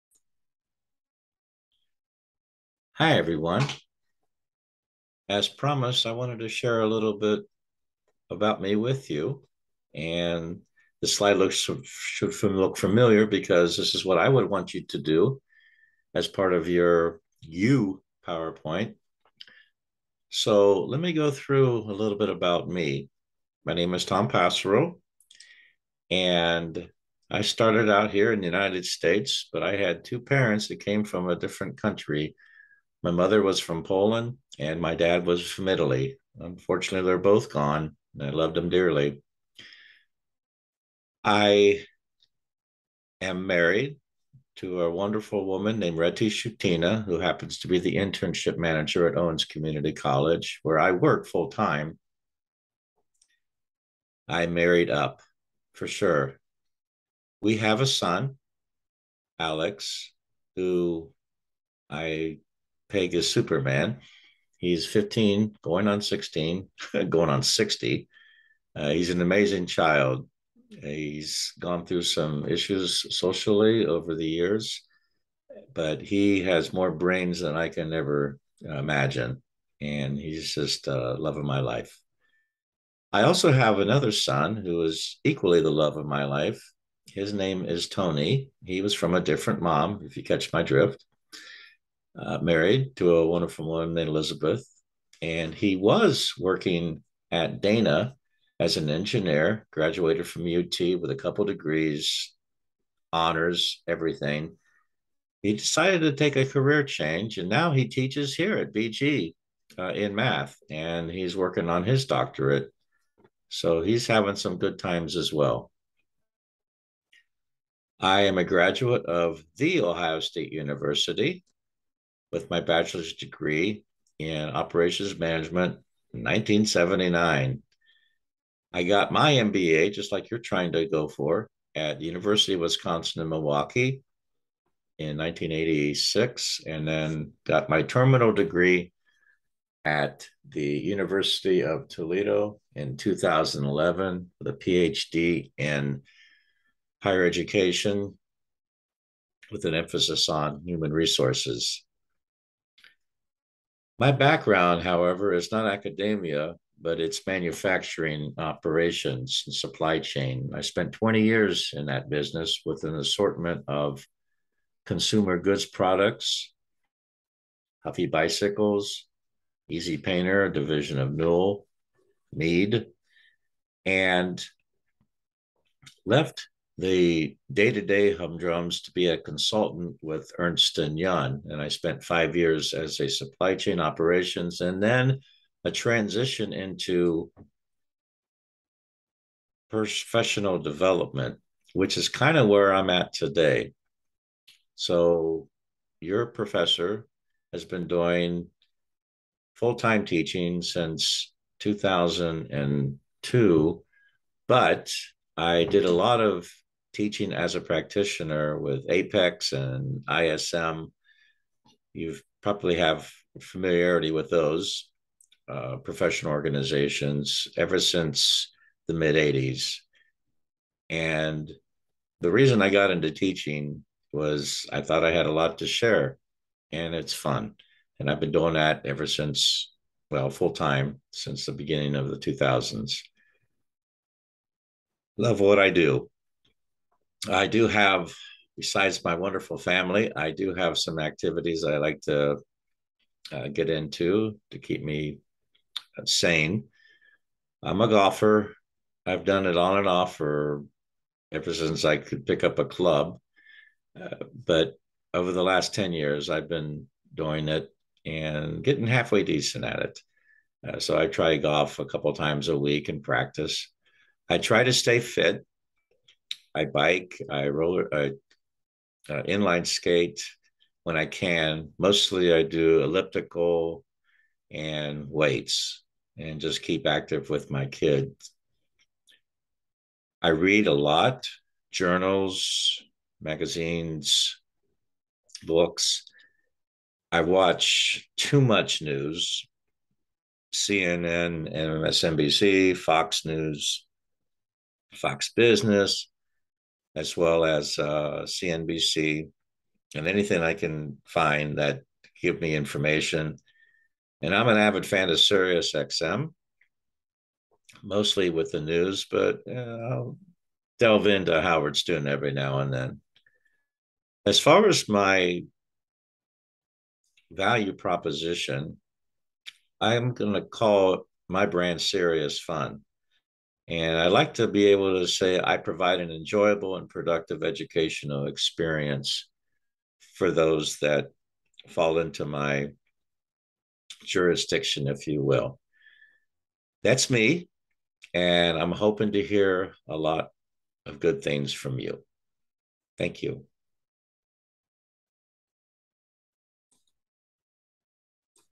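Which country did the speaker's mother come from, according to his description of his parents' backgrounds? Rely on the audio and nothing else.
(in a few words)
Poland.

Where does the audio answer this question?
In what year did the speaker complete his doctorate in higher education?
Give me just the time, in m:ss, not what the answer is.
2:22.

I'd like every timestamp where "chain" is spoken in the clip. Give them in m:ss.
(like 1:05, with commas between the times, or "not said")
2:39, 3:03.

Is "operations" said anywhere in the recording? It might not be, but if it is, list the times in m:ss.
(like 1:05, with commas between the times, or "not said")
2:04, 2:38, 3:03.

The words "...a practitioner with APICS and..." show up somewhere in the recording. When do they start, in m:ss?
3:27.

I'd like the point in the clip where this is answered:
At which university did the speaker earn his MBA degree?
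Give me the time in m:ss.
2:12.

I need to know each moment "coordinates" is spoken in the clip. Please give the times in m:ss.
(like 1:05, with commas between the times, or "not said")
not said.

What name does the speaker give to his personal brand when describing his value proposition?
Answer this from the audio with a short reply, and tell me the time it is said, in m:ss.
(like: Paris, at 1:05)
Serious Fun, at 5:21.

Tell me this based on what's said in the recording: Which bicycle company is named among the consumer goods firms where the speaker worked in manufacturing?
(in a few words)
Huffy.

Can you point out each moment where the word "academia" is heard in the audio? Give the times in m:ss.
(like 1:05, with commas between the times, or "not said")
2:35.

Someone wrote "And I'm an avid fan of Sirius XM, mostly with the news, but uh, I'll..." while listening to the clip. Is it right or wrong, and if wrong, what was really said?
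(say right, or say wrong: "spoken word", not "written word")
right.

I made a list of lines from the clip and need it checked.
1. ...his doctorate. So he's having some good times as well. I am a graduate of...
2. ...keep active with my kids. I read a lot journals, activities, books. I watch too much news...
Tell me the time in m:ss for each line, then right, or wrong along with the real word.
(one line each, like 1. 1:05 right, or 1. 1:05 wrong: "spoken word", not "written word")
1. 1:51 right
2. 4:36 wrong: "magazines", not "activities".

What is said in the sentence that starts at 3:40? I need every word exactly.
And the reason I got into teaching was I thought I had a lot to share and it's fun.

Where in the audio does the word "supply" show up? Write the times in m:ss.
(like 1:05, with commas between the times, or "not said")
2:39, 3:03.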